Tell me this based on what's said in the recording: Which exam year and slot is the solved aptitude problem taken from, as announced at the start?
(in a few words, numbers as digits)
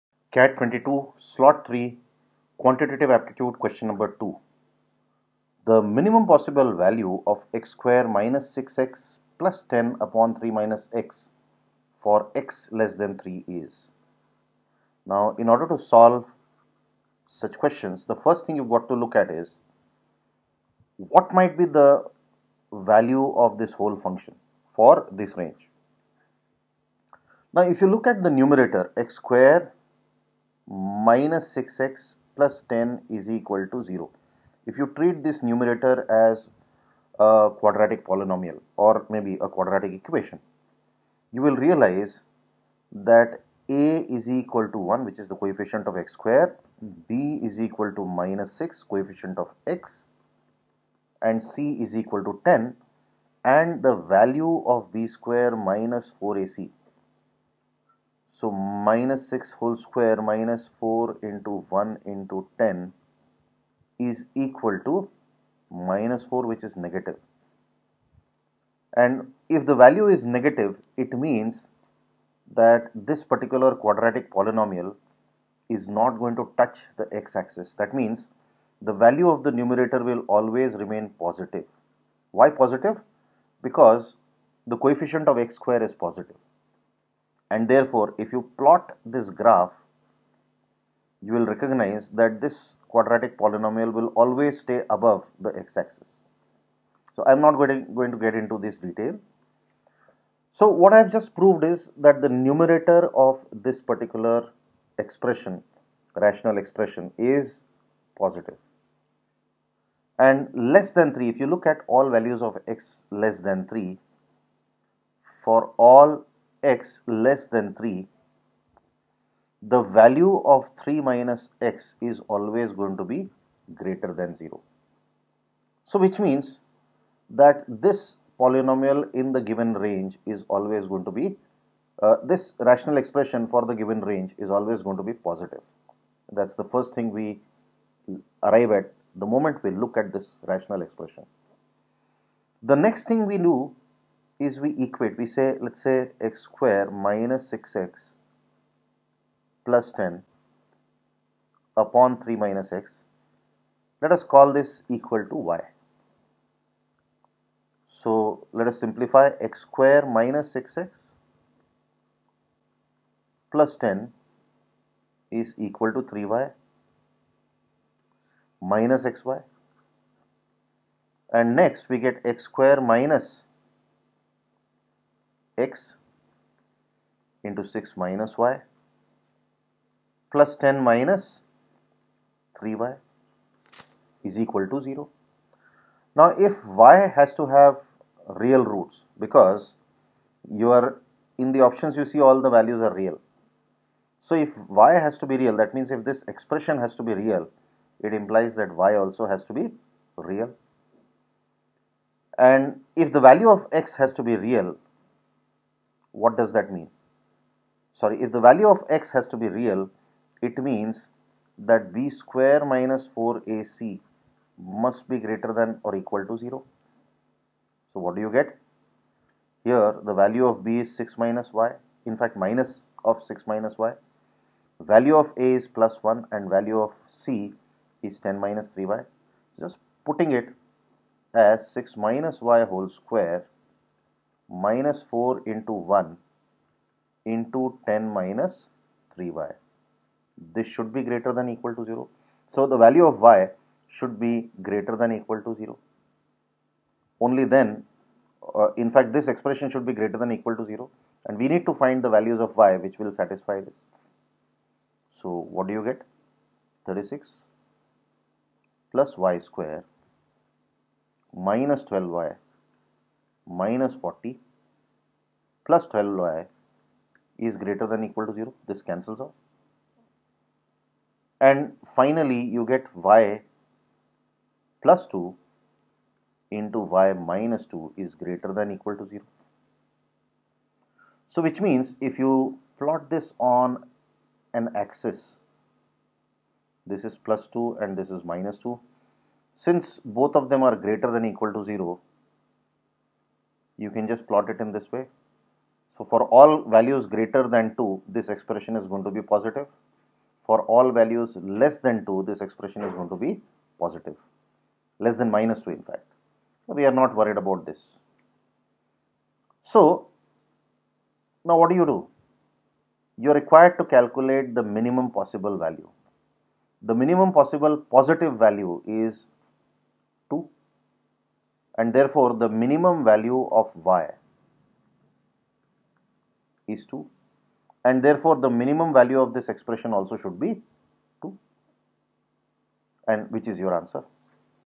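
CAT 22 slot 3.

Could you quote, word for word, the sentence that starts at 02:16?
That's the first thing we arrive at the moment we look at this rational expression.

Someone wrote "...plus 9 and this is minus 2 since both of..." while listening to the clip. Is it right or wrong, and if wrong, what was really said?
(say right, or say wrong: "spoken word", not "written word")
wrong: "2", not "9".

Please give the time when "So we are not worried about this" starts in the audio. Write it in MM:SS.
05:06.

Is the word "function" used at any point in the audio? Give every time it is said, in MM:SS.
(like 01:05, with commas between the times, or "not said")
00:24.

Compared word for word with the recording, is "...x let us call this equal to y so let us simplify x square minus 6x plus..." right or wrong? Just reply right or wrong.
right.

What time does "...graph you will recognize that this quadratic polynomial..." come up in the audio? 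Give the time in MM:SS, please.
01:29.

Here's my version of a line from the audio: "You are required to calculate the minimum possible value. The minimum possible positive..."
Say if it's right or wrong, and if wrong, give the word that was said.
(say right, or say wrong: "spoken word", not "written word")
right.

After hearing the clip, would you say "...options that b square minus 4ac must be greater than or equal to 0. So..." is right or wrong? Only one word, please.
wrong.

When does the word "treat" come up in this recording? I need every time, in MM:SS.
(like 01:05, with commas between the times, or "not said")
00:34.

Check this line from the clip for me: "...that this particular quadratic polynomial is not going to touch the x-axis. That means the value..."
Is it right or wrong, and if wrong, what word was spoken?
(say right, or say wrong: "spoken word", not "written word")
right.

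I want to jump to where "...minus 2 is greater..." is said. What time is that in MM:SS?
04:37.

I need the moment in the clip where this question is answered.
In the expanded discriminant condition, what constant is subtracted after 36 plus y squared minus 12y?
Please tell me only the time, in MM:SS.
04:23.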